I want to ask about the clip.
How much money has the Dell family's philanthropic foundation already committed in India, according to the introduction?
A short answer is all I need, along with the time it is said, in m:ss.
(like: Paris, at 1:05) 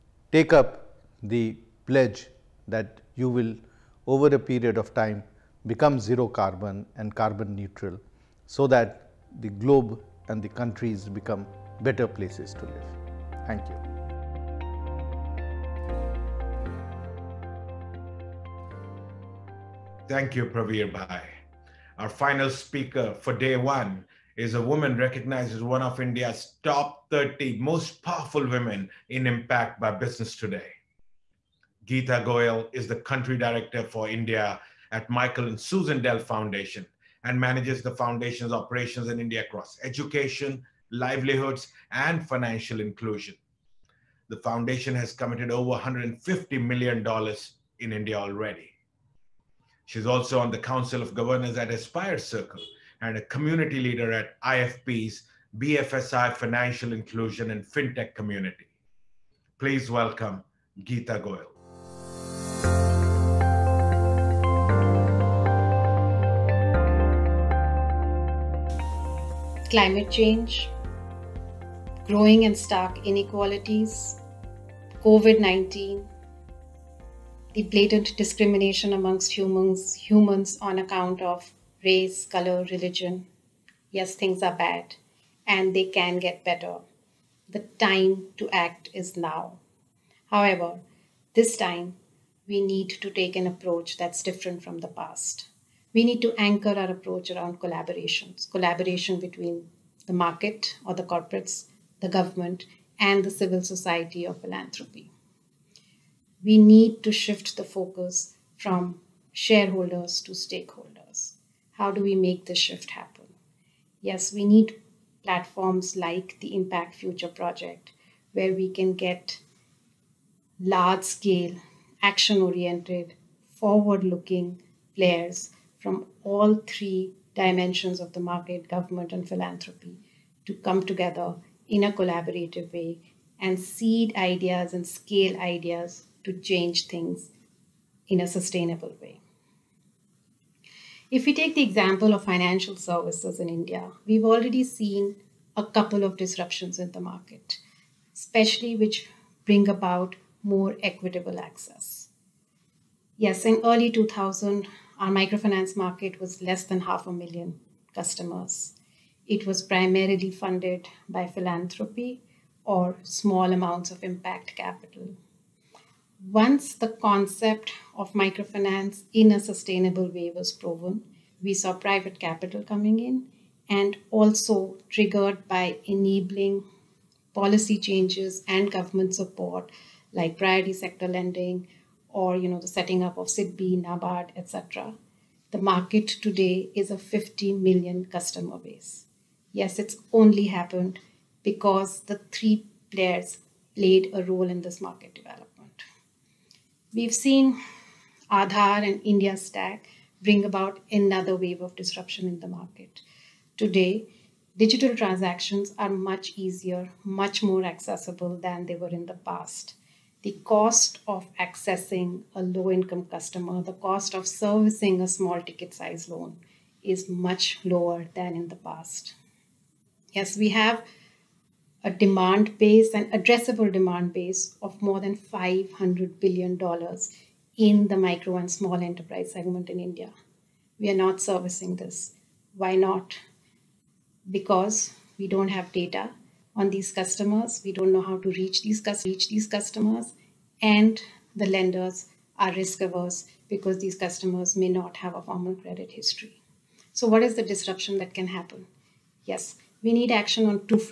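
$150 million, at 0:45.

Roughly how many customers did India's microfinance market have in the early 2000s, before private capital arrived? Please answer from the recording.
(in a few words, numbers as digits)
half a million.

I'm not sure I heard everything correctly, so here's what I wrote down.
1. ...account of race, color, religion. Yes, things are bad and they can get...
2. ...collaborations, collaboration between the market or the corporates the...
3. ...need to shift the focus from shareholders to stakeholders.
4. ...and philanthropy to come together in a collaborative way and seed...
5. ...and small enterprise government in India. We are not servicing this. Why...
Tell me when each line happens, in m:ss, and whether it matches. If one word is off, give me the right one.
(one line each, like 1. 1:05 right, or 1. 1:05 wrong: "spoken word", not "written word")
1. 1:20 right
2. 1:37 right
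3. 1:46 right
4. 2:09 right
5. 3:48 wrong: "segment", not "government".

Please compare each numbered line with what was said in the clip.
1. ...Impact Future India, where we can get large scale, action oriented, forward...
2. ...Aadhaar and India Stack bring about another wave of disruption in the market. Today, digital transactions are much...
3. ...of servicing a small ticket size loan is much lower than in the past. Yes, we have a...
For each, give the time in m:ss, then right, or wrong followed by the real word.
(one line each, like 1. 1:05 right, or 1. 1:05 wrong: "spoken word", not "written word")
1. 1:56 wrong: "Project", not "India"
2. 3:18 right
3. 3:34 right.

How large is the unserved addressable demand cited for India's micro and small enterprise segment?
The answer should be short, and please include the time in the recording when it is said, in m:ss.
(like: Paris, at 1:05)
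$500 billion, at 3:45.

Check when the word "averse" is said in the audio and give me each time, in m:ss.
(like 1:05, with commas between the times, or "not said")
4:02.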